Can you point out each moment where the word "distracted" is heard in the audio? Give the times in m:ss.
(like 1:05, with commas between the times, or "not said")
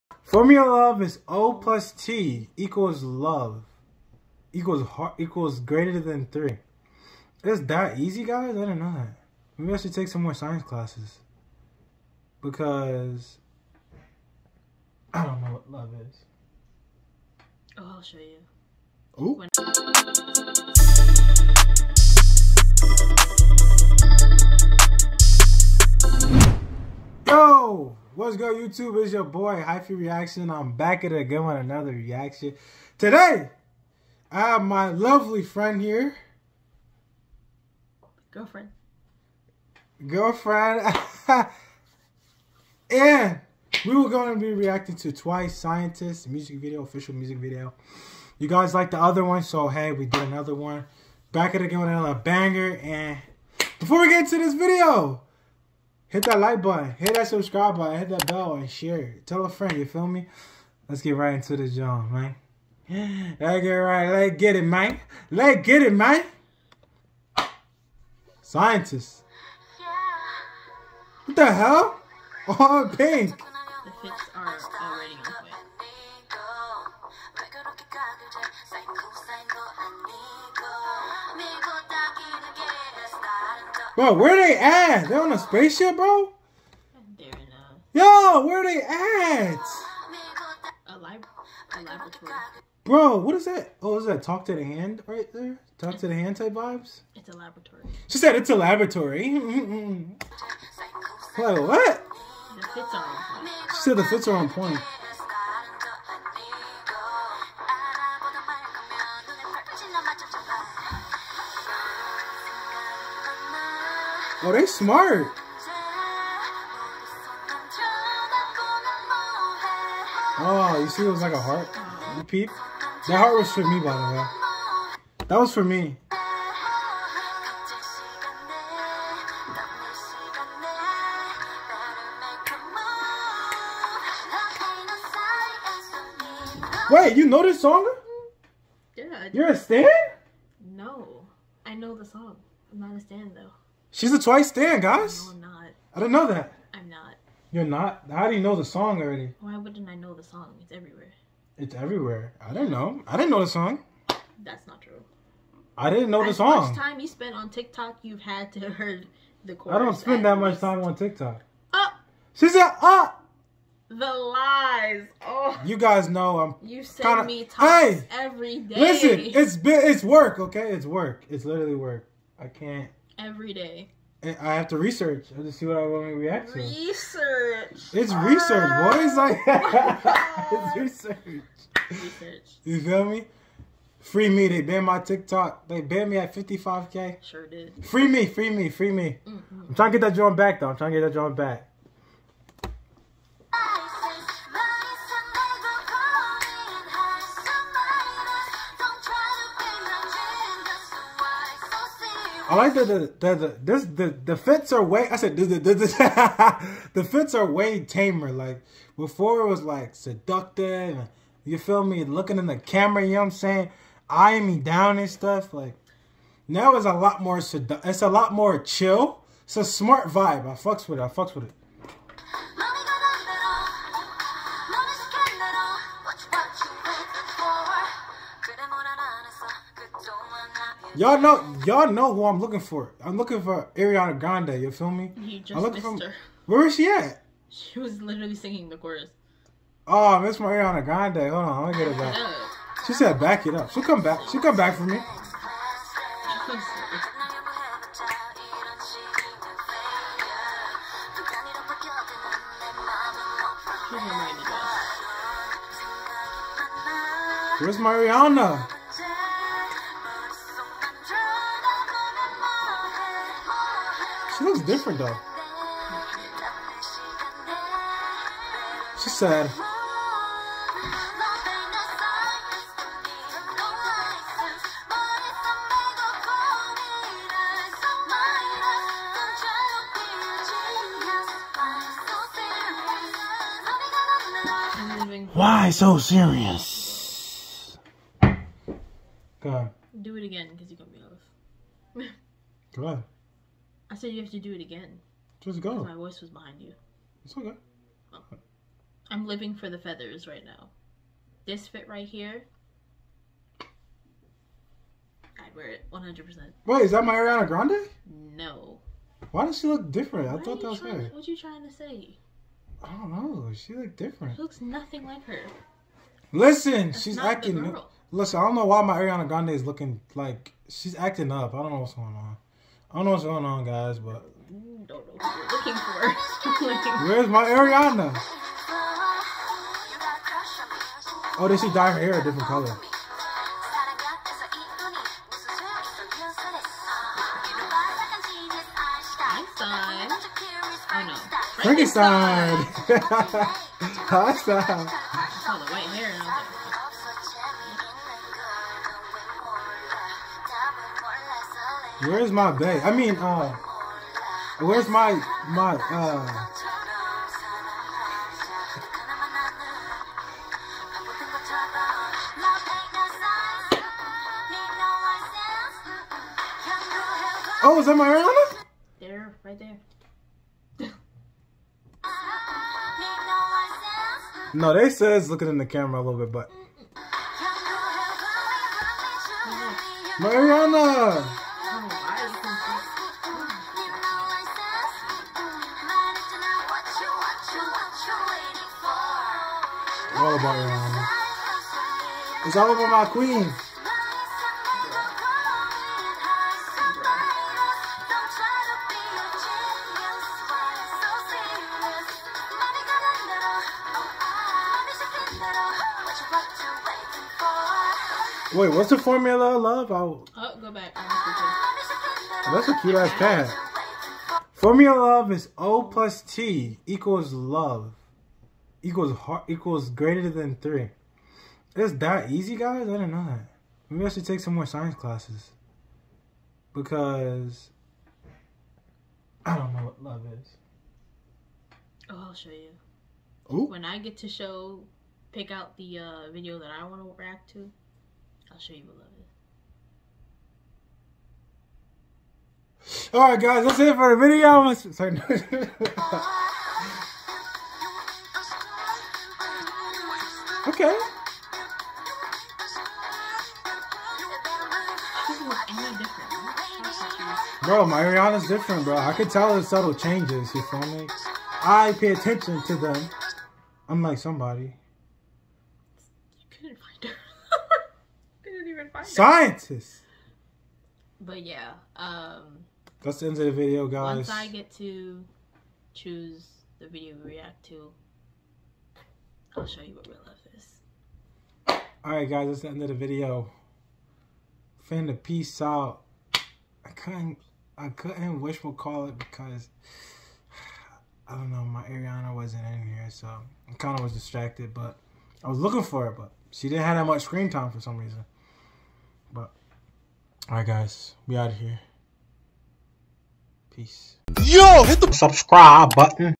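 8:14.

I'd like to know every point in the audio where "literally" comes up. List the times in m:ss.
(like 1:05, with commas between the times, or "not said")
2:51, 3:58.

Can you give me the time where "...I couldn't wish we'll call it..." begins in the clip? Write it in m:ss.
8:07.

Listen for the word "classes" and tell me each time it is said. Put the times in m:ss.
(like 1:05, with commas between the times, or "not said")
0:10, 7:04.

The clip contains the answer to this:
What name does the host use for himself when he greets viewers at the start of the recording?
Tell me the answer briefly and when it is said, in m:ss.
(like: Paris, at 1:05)
Hyphie Reaction, at 0:29.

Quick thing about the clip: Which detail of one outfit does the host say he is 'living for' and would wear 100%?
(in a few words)
feathers.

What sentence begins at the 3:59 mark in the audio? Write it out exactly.
Oh, I missed my Ariana Grande.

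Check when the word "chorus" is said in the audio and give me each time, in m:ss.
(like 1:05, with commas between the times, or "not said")
2:39, 3:58.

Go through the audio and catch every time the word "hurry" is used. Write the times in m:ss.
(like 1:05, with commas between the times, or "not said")
not said.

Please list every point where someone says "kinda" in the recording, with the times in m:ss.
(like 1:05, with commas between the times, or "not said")
2:47, 8:13.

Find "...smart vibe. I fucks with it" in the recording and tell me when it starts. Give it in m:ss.
3:39.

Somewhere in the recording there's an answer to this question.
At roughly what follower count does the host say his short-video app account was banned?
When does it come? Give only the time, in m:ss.
3:06.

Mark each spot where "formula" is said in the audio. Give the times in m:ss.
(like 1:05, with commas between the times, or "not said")
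0:00, 6:48, 6:54.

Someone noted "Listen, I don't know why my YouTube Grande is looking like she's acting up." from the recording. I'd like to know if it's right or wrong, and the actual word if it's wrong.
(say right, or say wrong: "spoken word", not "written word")
wrong: "Ariana", not "YouTube".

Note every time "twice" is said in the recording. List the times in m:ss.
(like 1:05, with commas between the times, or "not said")
0:45, 2:24.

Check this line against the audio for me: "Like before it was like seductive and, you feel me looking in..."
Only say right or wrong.
right.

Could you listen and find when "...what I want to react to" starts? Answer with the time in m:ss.
2:55.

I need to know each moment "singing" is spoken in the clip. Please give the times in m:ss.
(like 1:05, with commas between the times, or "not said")
3:58.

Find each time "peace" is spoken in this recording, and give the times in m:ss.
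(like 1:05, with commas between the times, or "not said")
8:05, 8:23.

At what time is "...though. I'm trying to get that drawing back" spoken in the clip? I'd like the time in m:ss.
3:10.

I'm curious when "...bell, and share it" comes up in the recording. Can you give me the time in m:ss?
0:58.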